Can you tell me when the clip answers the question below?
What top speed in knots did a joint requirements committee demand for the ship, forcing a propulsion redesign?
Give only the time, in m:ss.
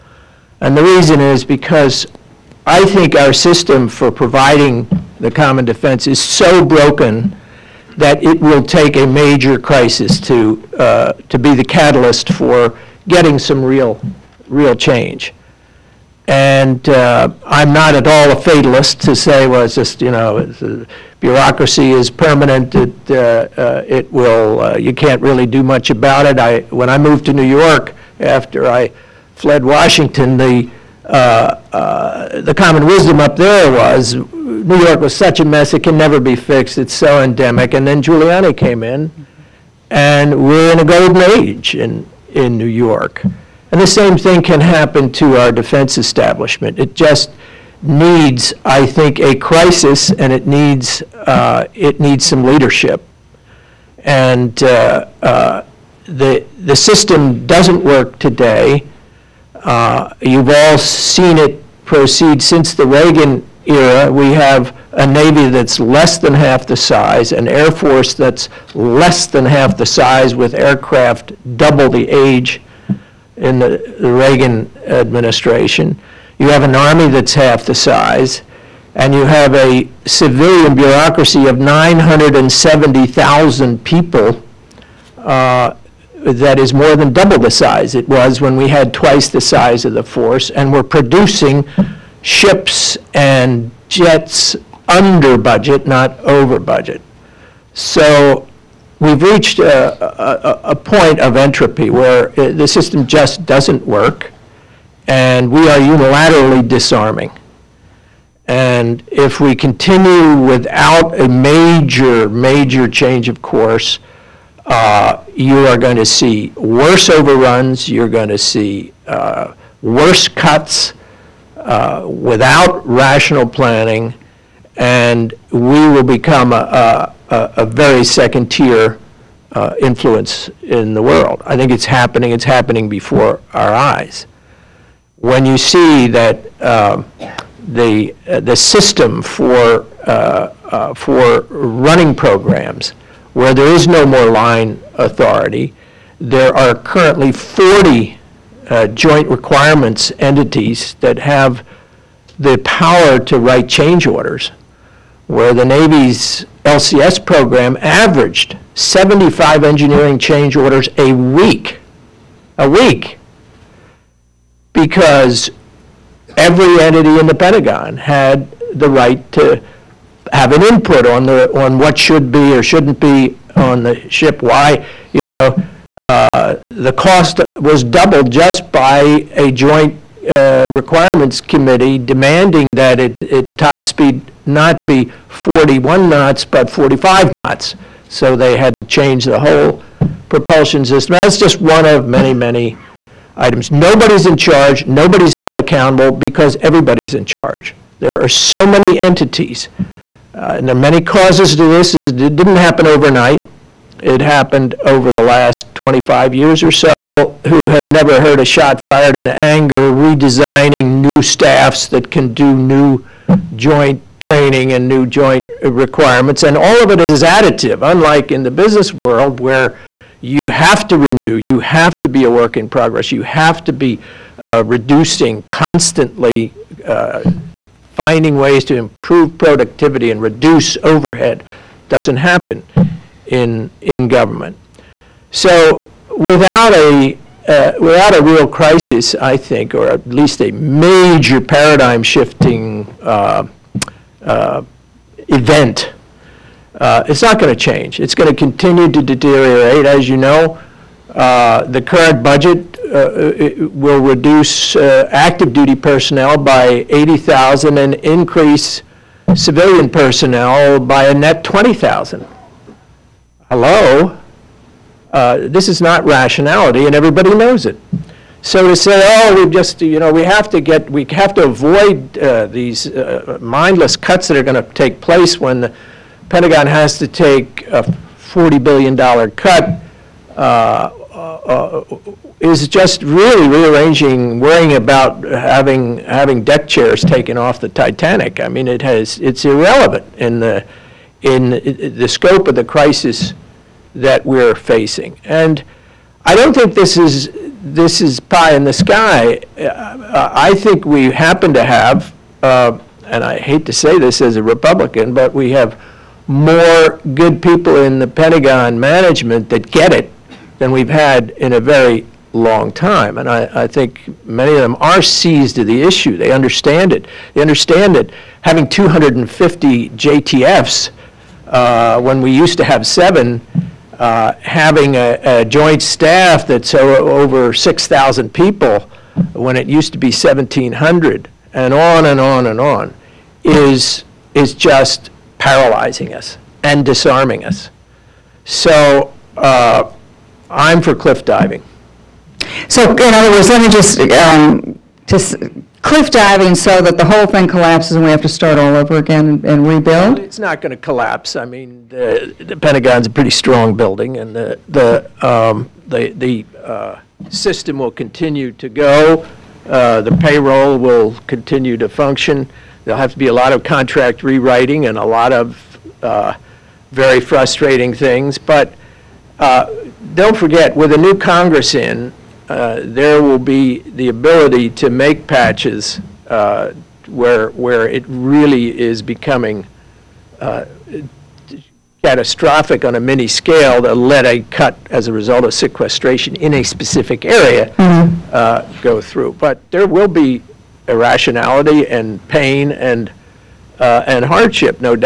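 3:06.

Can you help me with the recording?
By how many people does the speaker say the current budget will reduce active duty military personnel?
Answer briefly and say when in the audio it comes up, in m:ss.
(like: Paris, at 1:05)
80,000, at 4:16.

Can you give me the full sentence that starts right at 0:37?
And then Giuliani came in, and we're in a golden age in, in New York.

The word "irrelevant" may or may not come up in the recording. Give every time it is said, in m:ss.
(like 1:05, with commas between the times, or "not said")
4:49.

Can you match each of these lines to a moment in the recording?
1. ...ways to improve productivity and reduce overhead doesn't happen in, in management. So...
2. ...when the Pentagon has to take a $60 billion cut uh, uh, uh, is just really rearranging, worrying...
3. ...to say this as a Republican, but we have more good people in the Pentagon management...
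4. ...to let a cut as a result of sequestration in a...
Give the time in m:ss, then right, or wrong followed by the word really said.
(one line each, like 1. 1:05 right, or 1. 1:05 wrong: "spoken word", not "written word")
1. 3:48 wrong: "government", not "management"
2. 4:35 wrong: "40", not "60"
3. 5:03 right
4. 6:23 right.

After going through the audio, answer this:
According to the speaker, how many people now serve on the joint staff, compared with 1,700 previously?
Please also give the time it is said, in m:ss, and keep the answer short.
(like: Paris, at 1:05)
6,000, at 5:27.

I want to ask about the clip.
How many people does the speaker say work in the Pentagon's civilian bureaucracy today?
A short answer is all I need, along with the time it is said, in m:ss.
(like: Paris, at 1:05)
970,000, at 1:21.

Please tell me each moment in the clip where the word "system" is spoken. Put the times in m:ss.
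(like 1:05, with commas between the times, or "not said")
0:03, 0:56, 1:42, 2:18, 3:10, 5:57.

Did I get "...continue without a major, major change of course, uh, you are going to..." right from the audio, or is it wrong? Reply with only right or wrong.
right.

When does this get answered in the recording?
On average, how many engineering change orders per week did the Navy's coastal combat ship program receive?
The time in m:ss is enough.
2:38.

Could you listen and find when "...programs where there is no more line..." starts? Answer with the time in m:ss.
2:22.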